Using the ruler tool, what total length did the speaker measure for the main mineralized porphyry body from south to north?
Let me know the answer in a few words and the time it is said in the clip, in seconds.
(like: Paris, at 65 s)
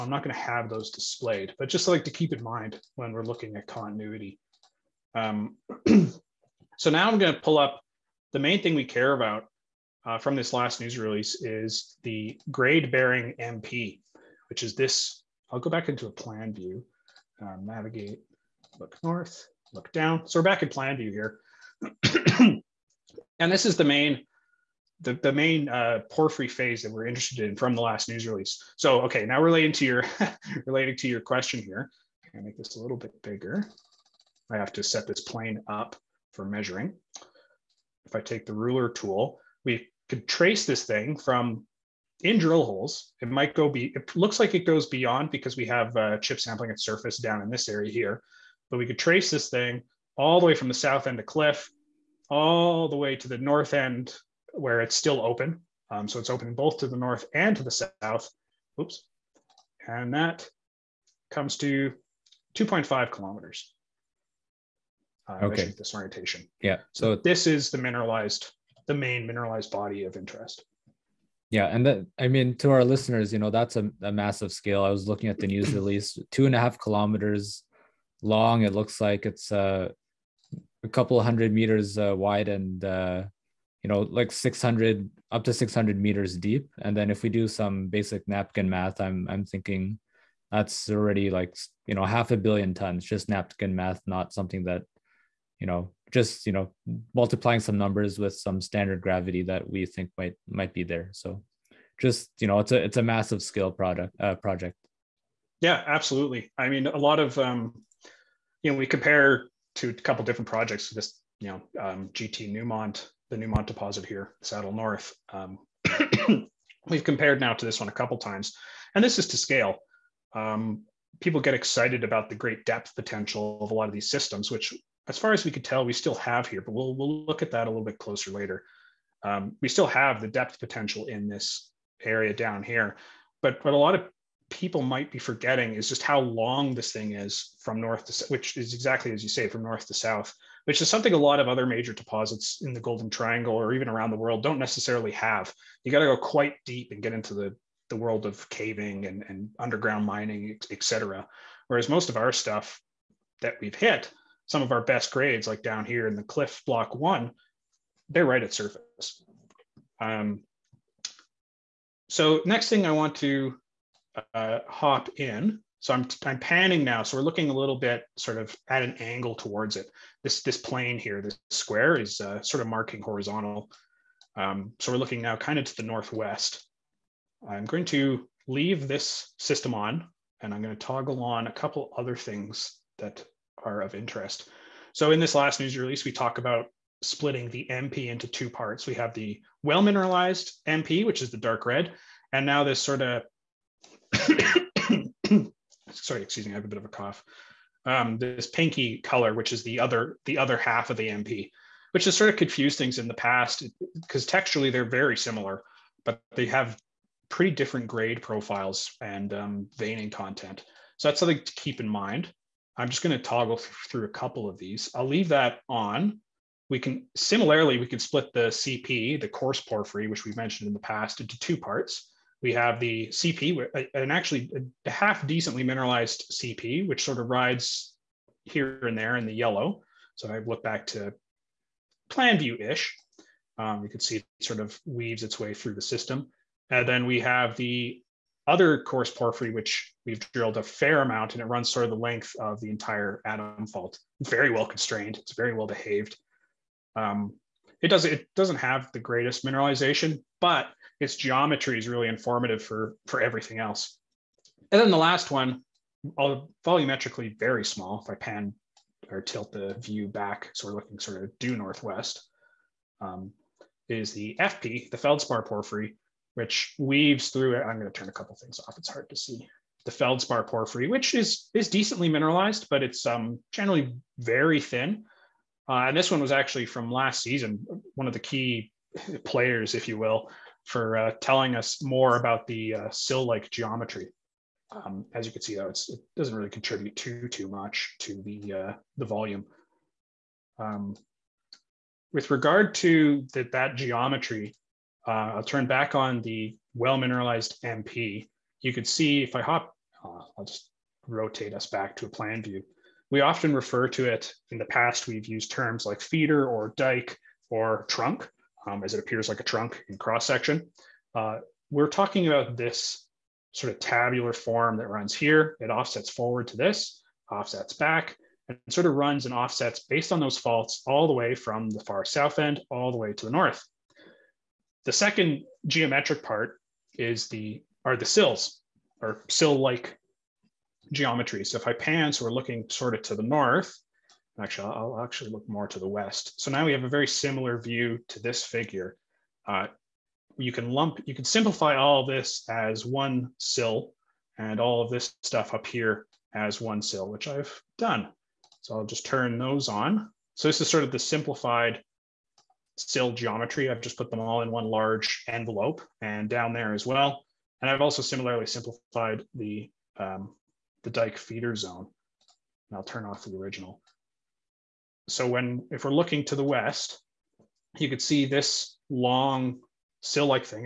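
2.5 kilometers, at 62 s.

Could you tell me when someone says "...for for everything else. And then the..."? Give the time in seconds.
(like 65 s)
252 s.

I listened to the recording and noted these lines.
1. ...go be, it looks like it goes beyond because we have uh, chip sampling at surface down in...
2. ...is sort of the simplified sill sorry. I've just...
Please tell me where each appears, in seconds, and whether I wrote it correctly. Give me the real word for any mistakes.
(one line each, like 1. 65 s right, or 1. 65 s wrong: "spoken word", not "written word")
1. 43 s right
2. 350 s wrong: "geometry", not "sorry".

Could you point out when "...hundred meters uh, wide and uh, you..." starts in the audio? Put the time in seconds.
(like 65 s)
81 s.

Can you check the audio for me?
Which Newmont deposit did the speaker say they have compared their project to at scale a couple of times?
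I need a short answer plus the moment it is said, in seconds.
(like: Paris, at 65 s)
Saddle North, at 114 s.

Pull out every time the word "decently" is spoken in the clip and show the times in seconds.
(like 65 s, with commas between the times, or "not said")
225 s, 271 s.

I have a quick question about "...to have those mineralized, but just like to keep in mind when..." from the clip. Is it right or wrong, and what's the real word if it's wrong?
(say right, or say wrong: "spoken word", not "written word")
wrong: "displayed", not "mineralized".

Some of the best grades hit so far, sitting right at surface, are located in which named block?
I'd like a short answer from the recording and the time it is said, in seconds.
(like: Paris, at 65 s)
Cliff block one, at 156 s.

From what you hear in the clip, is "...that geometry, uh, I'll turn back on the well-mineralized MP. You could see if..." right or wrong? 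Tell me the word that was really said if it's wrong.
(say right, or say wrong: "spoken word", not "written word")
right.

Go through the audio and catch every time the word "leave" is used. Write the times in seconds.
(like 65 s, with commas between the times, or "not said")
178 s, 215 s.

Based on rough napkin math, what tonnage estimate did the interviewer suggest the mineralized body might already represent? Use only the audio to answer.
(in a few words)
half a billion tons.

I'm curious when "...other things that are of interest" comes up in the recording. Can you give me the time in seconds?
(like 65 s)
181 s.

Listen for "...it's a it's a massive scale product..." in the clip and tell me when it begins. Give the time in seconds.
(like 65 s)
102 s.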